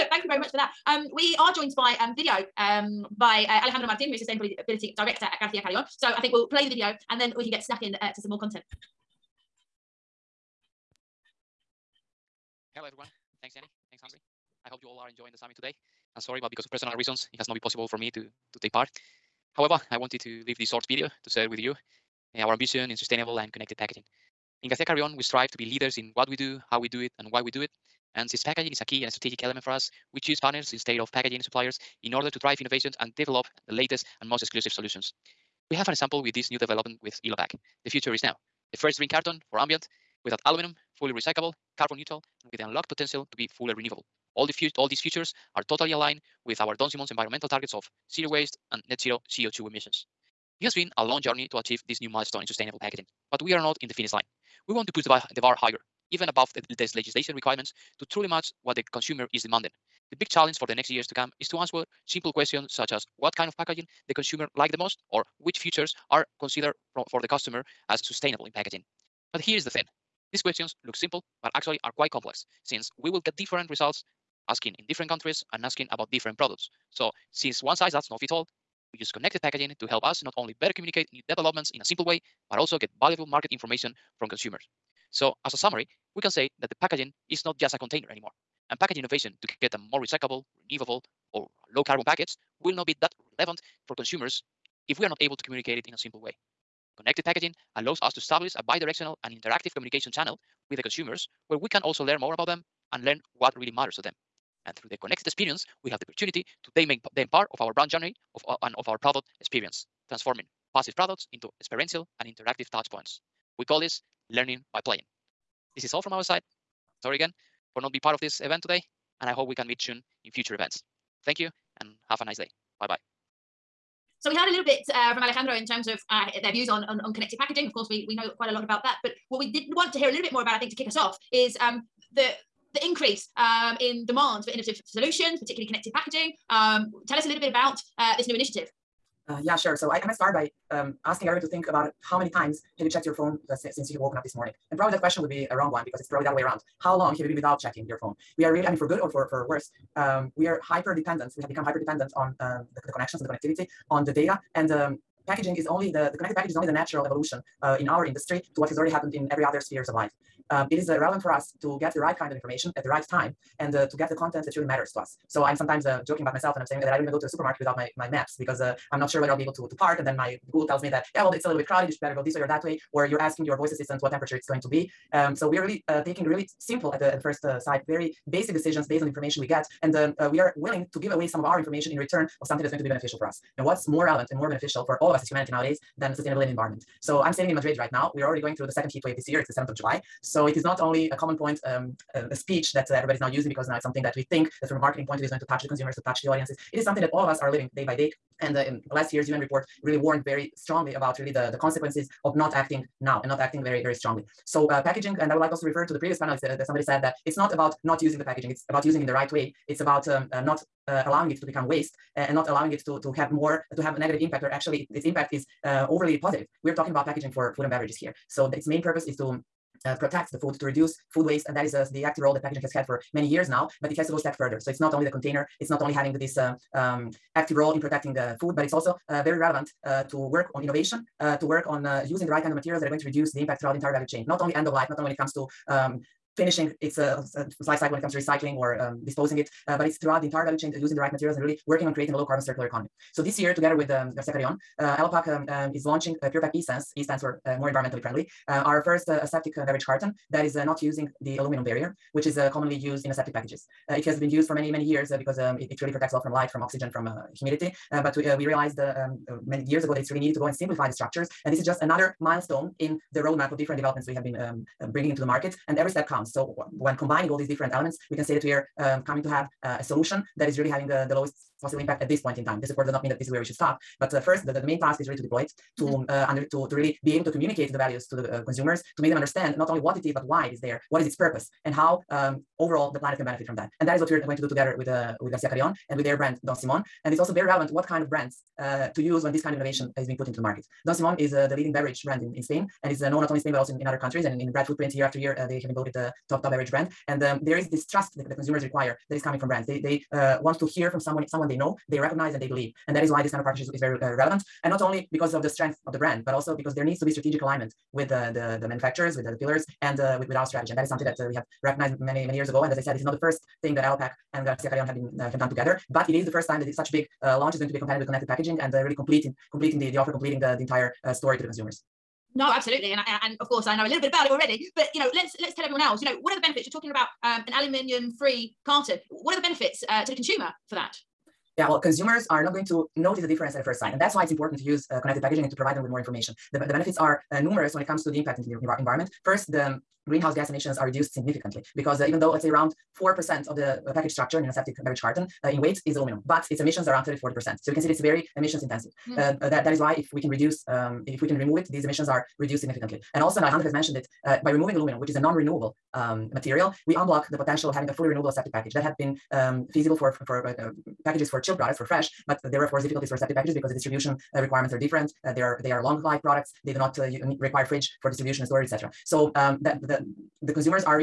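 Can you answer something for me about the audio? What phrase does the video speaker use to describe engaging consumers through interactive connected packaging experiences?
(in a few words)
Learning by playing.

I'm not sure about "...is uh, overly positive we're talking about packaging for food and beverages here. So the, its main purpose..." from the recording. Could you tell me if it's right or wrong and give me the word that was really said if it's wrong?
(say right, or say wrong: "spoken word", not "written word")
right.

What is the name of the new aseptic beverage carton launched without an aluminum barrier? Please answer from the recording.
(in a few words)
Pure-Pak eSense.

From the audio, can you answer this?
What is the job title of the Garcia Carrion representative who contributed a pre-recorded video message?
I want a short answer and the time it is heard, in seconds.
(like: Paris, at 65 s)
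Sustainability director, at 4 s.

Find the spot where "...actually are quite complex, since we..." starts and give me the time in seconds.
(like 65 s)
71 s.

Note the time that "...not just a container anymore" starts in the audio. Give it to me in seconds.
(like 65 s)
87 s.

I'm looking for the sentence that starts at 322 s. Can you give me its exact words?
No, absolutely, and I, uh, and of course I know a little bit about it already.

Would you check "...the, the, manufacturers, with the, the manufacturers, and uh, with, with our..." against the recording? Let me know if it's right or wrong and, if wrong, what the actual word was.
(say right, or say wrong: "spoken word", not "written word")
wrong: "pillars", not "manufacturers".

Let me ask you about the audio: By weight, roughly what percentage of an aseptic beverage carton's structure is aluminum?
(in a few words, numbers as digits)
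4%.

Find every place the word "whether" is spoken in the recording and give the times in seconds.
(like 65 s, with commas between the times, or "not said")
169 s.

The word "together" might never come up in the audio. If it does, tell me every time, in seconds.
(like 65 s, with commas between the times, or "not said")
243 s, 284 s, 315 s.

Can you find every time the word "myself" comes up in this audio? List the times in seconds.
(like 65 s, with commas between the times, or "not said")
166 s.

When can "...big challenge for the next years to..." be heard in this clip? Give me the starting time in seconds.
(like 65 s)
60 s.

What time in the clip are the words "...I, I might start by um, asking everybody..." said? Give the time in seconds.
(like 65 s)
139 s.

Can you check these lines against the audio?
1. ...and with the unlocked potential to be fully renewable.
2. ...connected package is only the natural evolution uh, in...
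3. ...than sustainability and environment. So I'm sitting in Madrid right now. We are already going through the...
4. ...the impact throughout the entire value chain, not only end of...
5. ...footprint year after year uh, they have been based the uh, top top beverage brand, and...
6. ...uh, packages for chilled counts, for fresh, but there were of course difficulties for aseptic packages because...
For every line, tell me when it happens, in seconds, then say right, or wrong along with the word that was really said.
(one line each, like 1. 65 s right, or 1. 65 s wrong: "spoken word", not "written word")
1. 42 s right
2. 156 s right
3. 185 s right
4. 233 s right
5. 294 s wrong: "voted", not "based"
6. 360 s wrong: "products", not "counts".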